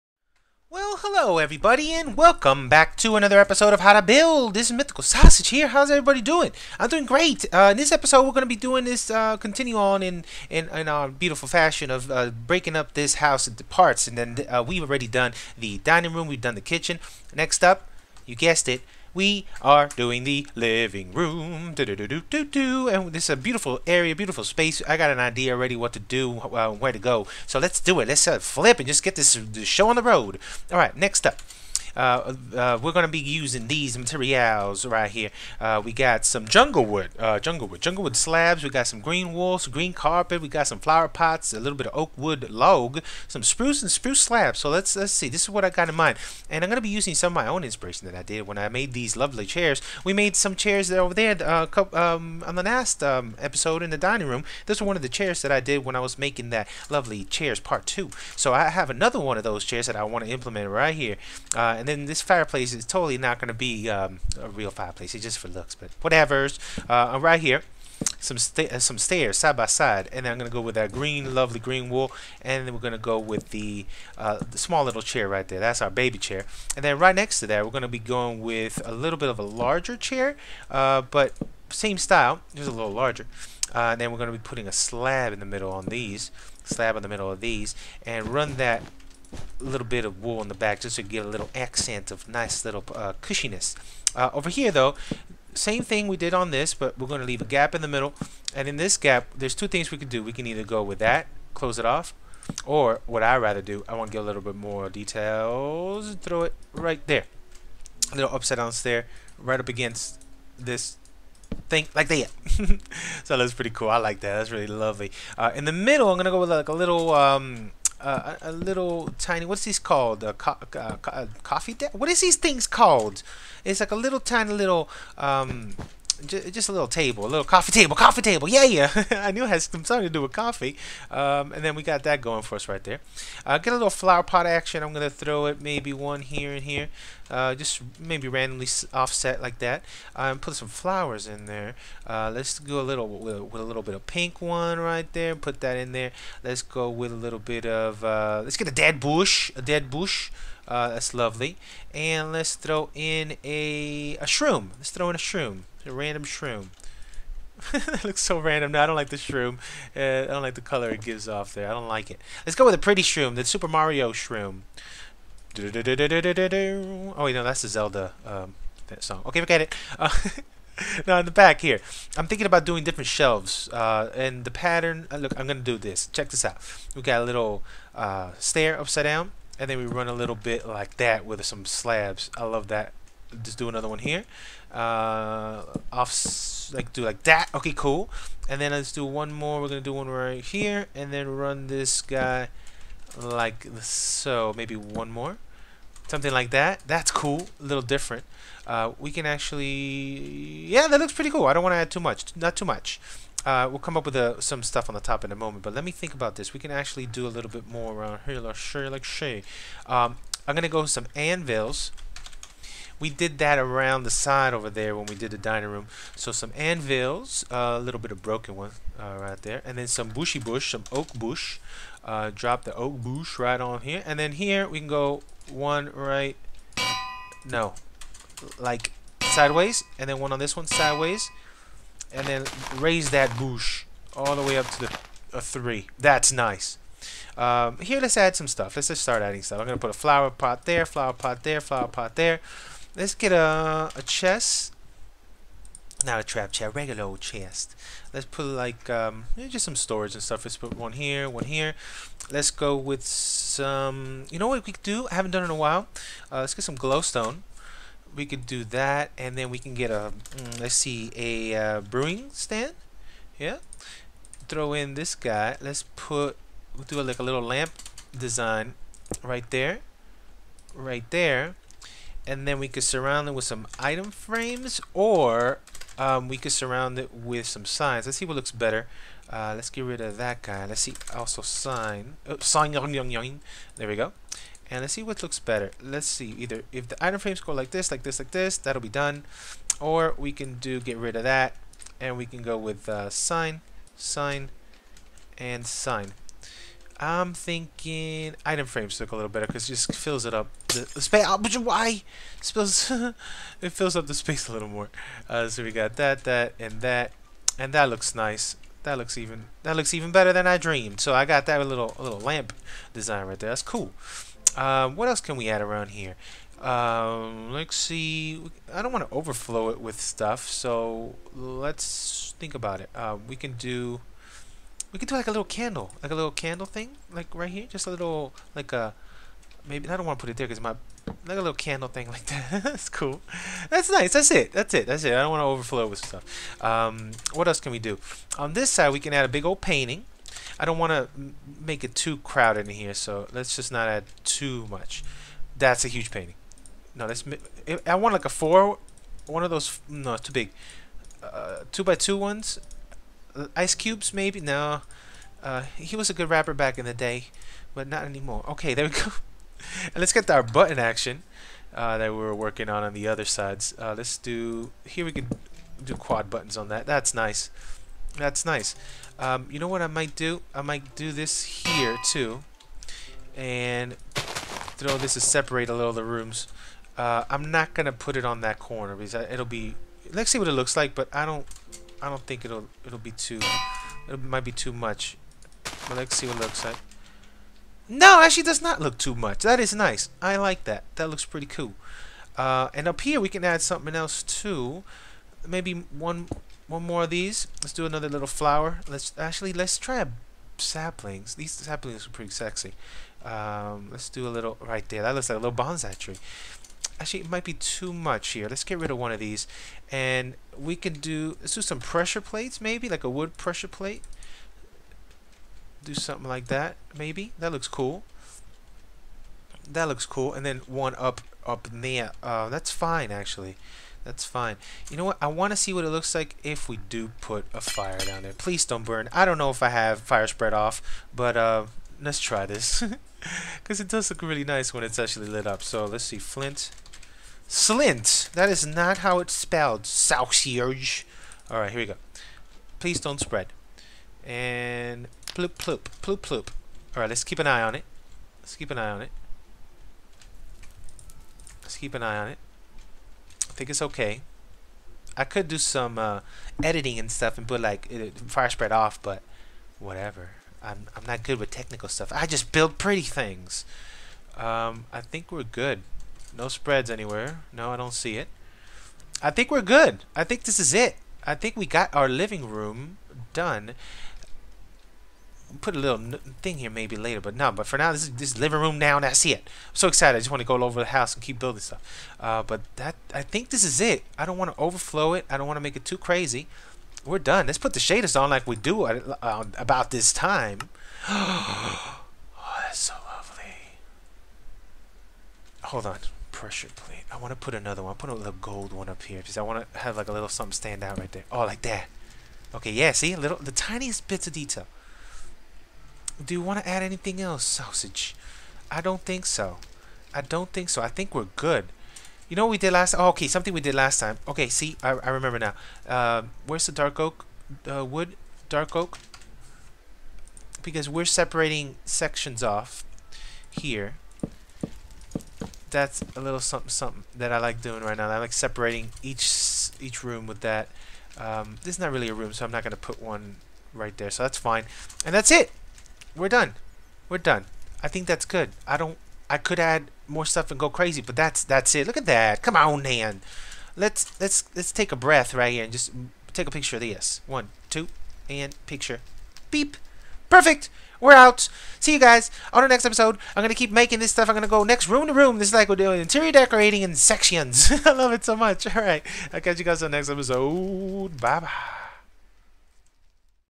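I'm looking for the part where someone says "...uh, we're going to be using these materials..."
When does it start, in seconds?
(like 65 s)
32 s.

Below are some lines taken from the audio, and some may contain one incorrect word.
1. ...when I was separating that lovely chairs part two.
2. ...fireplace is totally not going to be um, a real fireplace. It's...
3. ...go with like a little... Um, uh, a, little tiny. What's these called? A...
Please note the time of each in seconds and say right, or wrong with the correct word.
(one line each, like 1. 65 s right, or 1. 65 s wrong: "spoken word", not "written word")
1. 55 s wrong: "making", not "separating"
2. 62 s right
3. 116 s right.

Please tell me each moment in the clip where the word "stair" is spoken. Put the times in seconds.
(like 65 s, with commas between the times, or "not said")
68 s, 108 s, 178 s.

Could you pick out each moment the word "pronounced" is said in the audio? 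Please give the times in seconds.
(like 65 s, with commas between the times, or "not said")
not said.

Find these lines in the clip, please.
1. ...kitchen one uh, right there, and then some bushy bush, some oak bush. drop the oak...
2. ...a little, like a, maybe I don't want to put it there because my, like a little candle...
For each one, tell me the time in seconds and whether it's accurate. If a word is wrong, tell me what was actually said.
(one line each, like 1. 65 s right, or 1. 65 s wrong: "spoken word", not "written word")
1. 218 s wrong: "broken", not "kitchen"
2. 327 s right.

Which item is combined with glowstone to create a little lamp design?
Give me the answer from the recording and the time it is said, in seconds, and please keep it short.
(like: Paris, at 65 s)
Brewing stand, at 261 s.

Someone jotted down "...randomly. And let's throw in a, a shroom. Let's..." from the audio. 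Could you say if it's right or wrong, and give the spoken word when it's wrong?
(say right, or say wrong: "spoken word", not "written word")
wrong: "lovely", not "randomly".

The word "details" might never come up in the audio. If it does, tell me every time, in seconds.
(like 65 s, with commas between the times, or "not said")
104 s, 504 s.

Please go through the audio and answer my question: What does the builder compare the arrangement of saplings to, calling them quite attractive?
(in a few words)
Bonsai tree.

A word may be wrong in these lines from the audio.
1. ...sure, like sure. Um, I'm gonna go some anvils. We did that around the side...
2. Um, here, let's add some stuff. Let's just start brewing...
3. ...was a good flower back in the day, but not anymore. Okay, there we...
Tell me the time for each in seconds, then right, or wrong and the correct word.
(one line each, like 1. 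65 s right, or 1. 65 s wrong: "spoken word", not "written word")
1. 208 s right
2. 237 s wrong: "adding", not "brewing"
3. 355 s wrong: "rapper", not "flower".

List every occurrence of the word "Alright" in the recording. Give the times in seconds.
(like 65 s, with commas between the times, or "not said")
441 s, 446 s.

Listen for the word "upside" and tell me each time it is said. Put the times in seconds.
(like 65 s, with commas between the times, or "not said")
108 s, 178 s.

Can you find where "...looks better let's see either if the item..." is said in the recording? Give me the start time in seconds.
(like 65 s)
285 s.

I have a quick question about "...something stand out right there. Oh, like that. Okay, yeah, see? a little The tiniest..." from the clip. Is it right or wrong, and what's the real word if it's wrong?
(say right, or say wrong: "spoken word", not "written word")
right.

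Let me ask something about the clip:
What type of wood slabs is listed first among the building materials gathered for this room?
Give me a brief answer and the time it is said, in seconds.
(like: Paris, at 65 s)
Jungle wood slabs, at 37 s.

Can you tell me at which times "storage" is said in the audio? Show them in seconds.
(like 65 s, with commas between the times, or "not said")
249 s.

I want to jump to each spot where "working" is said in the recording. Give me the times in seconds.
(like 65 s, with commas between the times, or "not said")
362 s.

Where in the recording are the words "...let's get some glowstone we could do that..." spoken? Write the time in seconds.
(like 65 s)
256 s.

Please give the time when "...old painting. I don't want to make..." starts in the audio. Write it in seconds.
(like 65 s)
339 s.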